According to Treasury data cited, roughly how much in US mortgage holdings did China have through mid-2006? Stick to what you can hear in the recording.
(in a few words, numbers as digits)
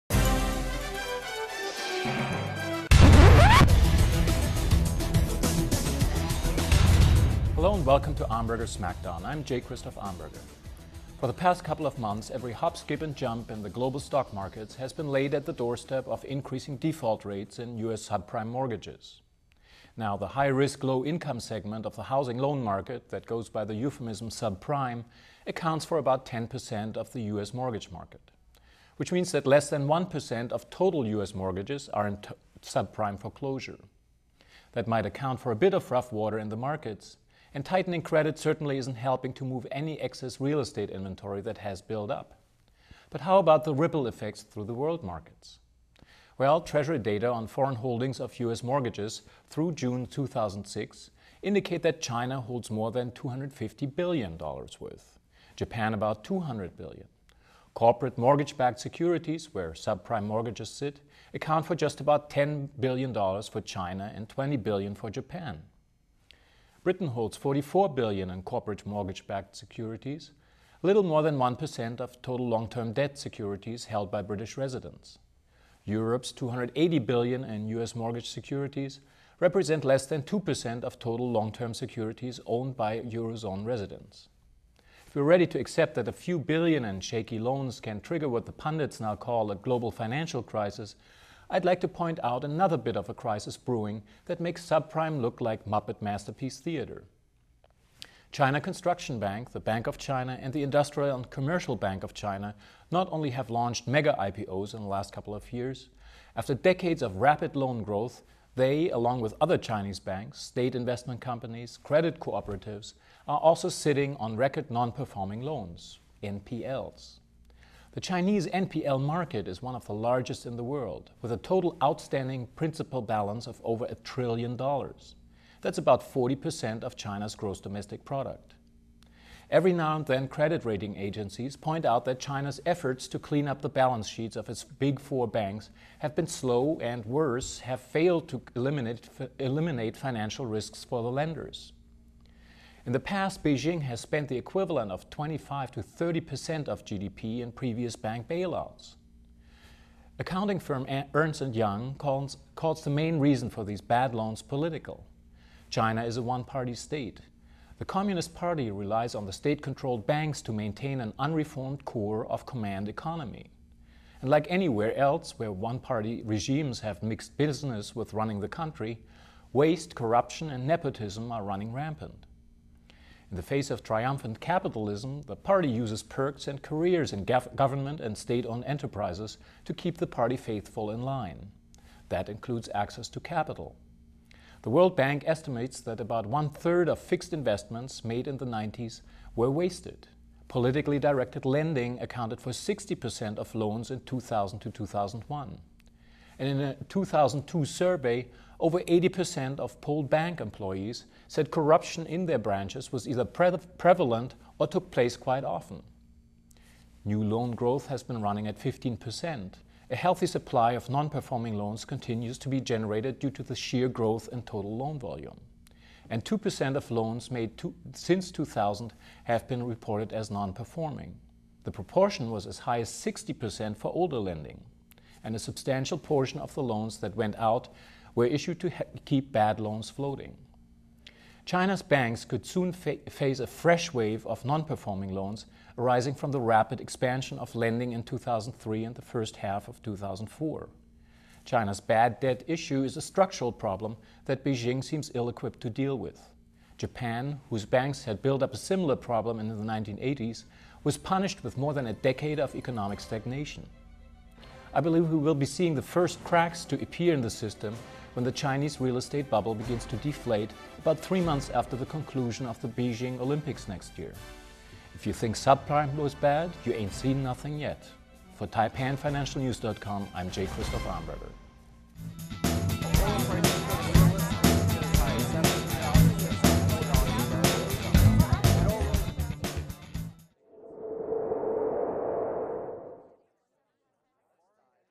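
$250 billion.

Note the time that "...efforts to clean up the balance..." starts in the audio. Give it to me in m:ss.
2:12.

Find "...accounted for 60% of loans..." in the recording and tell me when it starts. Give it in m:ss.
3:11.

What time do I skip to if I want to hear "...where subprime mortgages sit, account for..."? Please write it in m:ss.
0:59.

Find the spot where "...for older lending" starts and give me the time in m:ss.
3:43.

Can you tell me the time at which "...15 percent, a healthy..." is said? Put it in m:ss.
3:28.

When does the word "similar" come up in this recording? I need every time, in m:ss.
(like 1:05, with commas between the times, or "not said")
4:08.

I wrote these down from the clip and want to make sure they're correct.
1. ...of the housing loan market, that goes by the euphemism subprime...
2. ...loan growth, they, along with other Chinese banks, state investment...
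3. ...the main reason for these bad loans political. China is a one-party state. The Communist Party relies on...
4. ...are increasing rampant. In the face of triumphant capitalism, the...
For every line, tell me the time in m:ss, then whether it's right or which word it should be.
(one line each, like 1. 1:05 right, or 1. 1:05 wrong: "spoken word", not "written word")
1. 0:21 right
2. 1:47 right
3. 2:32 right
4. 2:51 wrong: "running", not "increasing".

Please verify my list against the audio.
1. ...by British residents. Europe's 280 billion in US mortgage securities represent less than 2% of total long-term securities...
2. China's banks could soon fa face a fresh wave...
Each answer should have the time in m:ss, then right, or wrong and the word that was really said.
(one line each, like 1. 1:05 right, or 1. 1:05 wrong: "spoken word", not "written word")
1. 1:14 right
2. 3:51 right.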